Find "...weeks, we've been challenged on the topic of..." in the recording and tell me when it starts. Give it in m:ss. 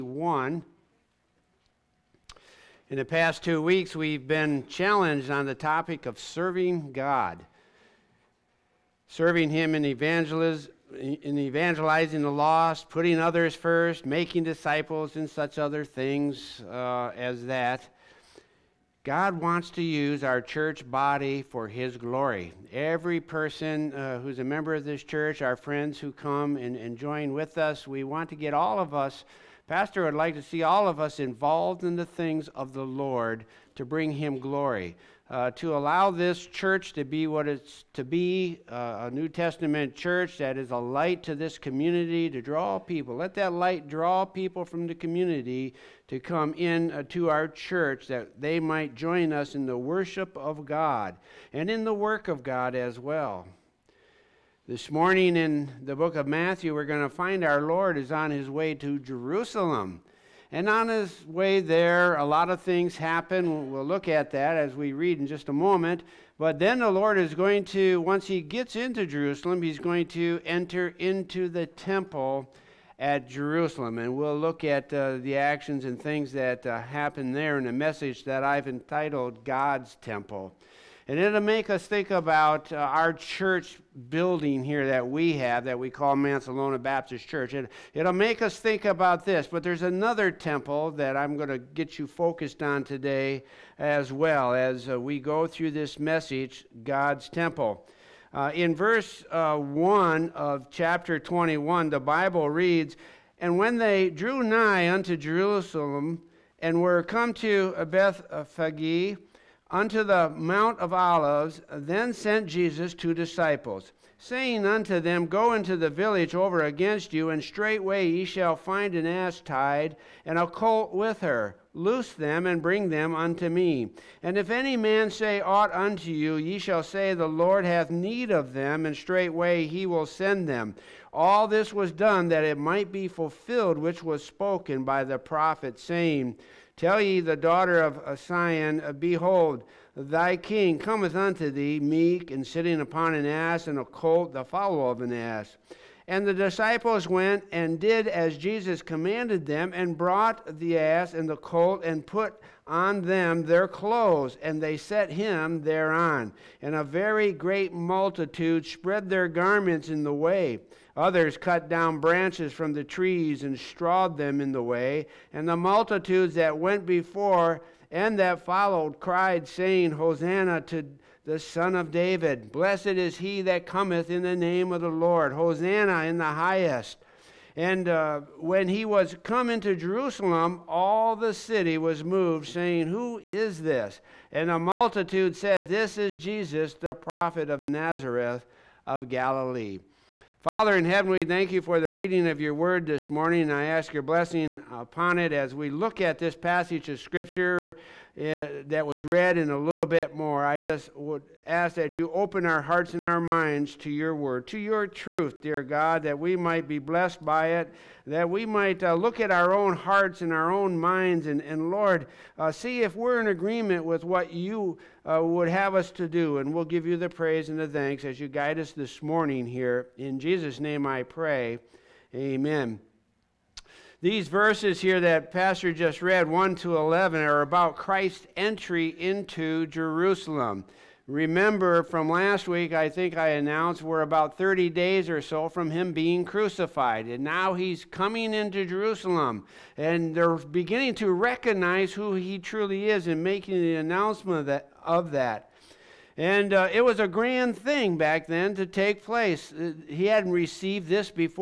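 0:03.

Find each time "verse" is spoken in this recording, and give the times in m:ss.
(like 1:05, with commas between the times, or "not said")
1:38, 3:44.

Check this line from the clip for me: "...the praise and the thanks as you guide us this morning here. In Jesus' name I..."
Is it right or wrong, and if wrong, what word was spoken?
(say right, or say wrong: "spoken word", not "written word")
right.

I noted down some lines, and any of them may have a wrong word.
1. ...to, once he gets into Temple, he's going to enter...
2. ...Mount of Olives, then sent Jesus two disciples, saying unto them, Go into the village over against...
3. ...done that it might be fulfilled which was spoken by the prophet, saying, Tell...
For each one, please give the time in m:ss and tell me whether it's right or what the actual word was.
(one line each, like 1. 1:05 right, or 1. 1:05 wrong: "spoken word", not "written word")
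1. 1:07 wrong: "Jerusalem", not "Temple"
2. 1:50 right
3. 2:11 right.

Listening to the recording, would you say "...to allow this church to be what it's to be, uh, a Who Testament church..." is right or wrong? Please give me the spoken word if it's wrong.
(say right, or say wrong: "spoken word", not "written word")
wrong: "New", not "Who".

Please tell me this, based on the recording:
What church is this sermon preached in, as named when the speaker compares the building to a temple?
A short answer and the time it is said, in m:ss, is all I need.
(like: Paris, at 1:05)
Mancelona Baptist Church, at 1:26.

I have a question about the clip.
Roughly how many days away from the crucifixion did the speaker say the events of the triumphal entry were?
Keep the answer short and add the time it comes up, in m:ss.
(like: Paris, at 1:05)
30, at 3:54.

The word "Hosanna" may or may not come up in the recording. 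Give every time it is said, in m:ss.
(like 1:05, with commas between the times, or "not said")
2:49, 2:55.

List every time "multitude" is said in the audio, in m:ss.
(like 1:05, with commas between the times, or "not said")
2:37, 2:45, 3:04.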